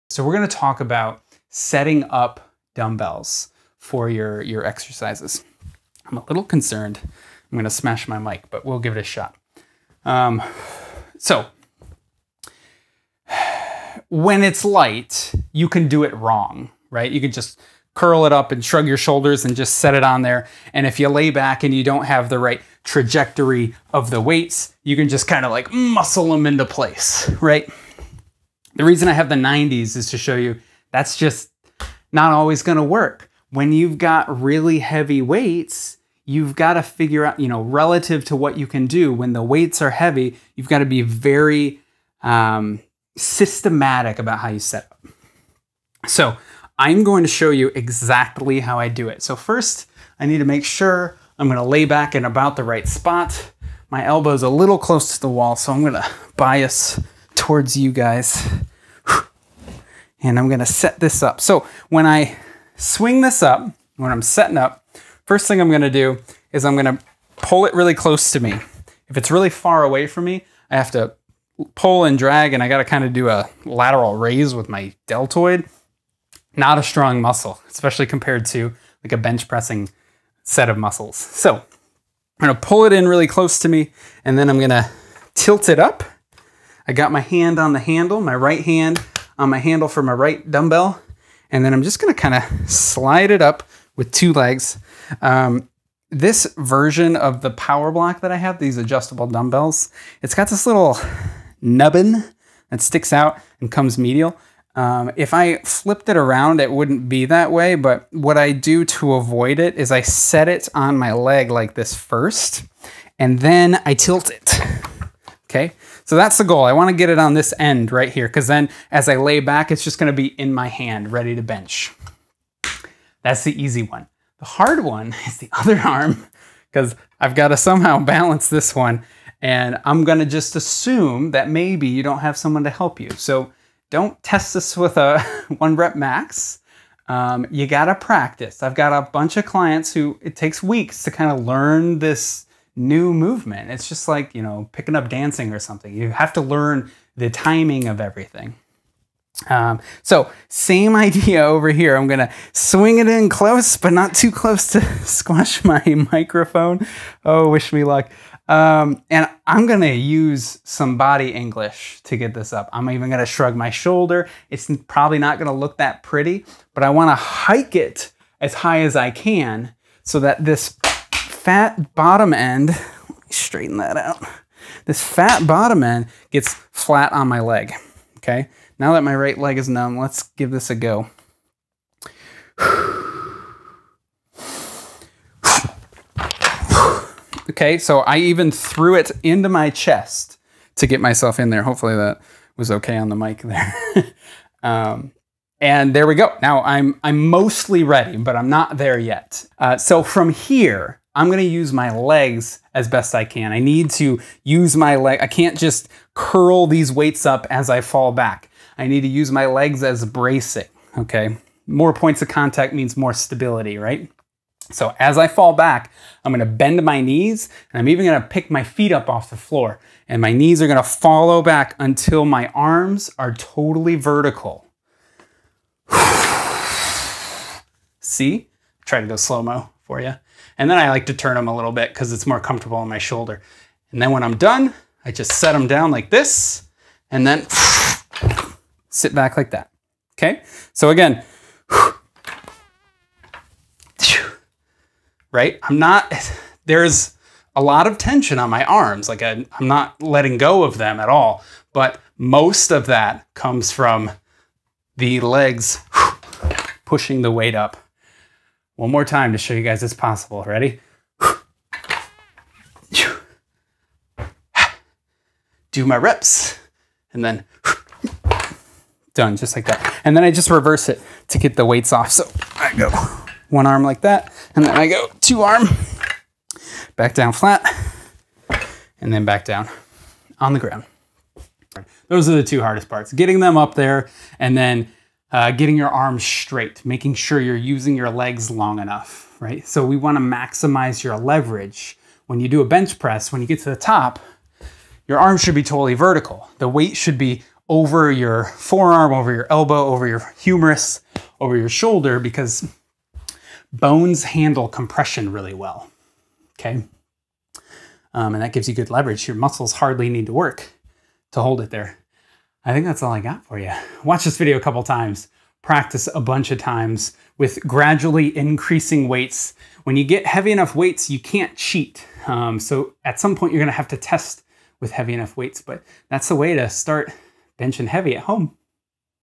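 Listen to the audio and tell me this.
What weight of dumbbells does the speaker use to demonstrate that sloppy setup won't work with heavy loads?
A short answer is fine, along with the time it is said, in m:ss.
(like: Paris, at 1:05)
90s, at 0:29.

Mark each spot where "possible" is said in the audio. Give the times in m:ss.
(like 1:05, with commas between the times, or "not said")
4:19.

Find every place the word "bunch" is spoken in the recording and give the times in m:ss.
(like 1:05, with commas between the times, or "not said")
2:19, 5:16.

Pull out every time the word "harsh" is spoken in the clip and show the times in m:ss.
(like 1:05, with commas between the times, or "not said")
not said.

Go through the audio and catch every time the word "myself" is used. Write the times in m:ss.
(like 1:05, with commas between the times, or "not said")
3:11.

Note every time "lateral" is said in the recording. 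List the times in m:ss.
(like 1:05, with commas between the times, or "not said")
1:13.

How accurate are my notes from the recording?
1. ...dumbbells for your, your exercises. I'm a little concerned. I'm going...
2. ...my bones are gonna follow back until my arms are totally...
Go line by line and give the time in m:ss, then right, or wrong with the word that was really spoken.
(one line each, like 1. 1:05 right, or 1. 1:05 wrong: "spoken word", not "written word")
1. 0:02 right
2. 3:40 wrong: "knees", not "bones".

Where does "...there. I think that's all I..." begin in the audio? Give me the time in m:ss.
5:11.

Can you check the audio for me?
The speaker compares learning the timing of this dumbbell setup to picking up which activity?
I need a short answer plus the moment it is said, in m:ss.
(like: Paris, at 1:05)
dancing, at 2:25.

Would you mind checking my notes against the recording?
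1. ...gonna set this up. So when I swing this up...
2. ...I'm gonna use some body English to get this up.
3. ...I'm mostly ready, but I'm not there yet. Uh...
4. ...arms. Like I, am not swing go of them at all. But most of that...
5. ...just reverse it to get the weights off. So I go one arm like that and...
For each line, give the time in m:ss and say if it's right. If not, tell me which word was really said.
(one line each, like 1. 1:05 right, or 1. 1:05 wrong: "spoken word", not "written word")
1. 1:00 right
2. 2:39 right
3. 3:17 right
4. 4:08 wrong: "letting", not "swing"
5. 4:30 right.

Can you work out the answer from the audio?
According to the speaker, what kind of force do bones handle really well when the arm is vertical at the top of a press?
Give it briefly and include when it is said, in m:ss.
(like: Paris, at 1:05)
compression, at 5:04.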